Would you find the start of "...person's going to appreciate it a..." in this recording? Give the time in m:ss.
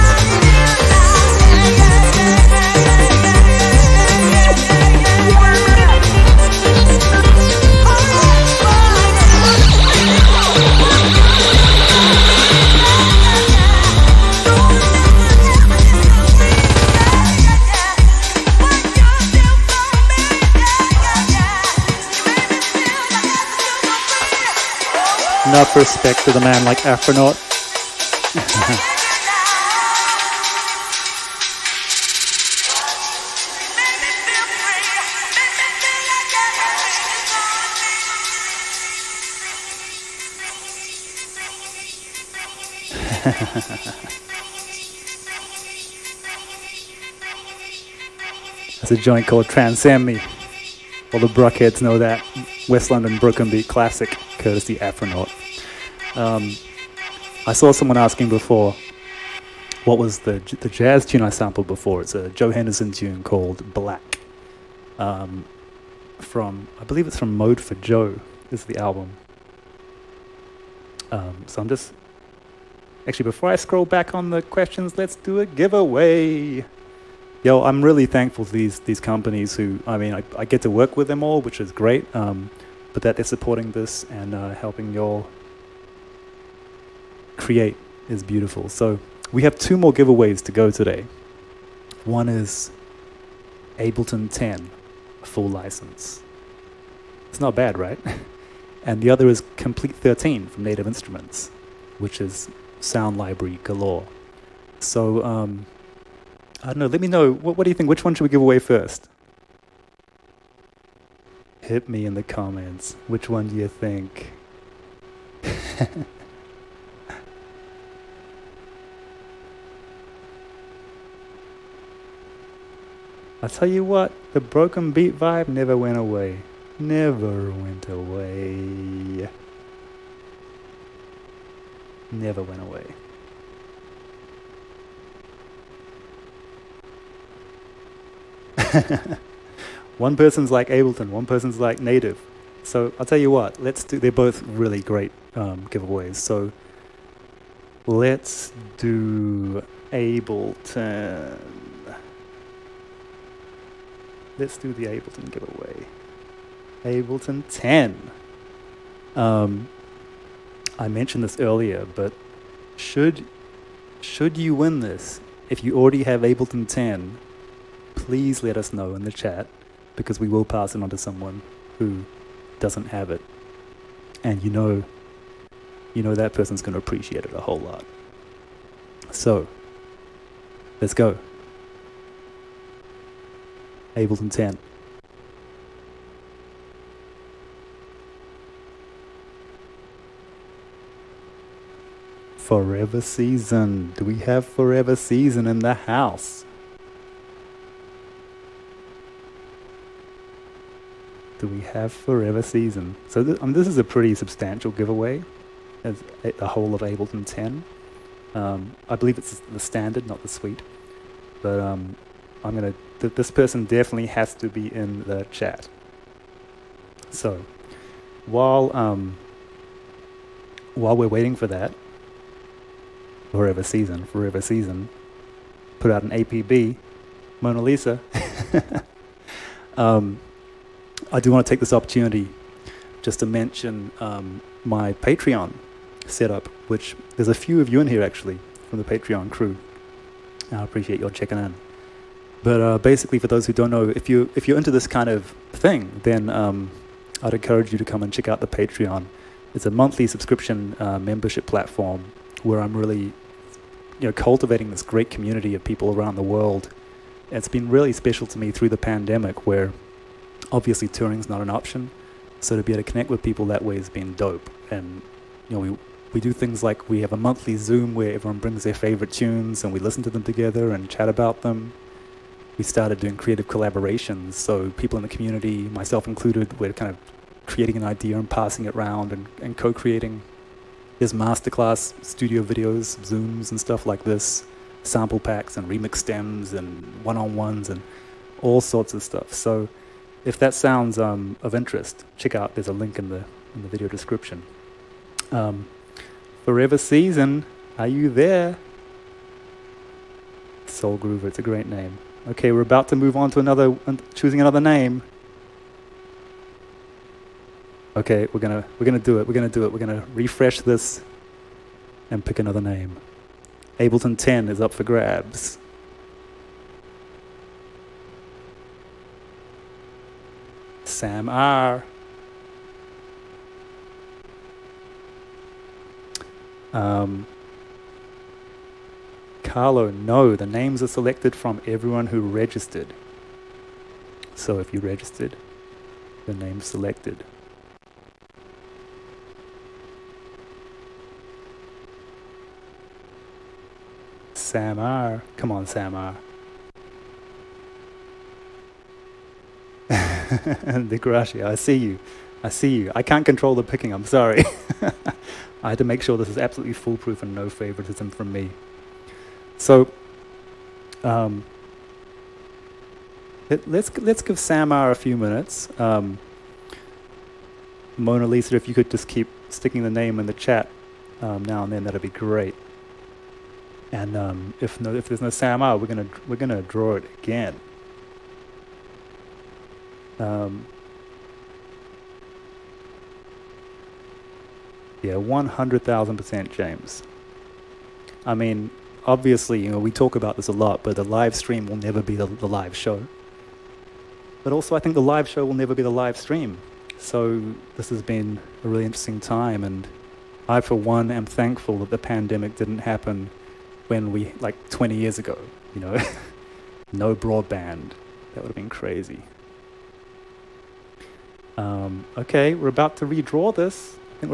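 2:56.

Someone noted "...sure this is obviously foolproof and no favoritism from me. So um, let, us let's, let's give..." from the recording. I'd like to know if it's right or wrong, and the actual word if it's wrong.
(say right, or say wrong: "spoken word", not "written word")
wrong: "absolutely", not "obviously".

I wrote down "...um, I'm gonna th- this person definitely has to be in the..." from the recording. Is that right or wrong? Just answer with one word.
right.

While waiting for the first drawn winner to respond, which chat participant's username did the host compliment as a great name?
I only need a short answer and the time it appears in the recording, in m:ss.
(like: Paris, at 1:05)
Soul Groover, at 5:00.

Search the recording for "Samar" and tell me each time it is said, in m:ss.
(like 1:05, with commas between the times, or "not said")
6:04, 6:15.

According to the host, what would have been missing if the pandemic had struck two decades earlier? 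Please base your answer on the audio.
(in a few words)
broadband.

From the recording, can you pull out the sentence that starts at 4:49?
So if that sounds um, of interest, check out, there's a link in the, in the video description.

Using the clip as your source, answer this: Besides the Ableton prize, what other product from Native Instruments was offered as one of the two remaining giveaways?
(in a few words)
Komplete 13.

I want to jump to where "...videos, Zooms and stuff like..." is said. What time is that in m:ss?
4:42.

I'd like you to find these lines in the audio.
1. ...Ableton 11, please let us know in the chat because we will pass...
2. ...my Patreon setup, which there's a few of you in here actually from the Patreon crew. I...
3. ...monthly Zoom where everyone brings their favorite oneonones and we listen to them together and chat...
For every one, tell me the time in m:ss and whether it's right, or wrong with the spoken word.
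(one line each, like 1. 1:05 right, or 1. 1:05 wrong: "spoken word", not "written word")
1. 2:46 wrong: "10", not "11"
2. 3:54 right
3. 4:27 wrong: "tunes", not "oneonones".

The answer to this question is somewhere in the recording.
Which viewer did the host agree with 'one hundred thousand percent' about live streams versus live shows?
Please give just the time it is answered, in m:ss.
6:26.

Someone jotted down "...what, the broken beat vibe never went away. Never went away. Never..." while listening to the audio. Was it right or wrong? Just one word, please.
right.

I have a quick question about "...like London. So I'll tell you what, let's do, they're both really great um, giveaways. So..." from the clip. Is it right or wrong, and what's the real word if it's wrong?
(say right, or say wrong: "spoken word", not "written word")
wrong: "Native", not "London".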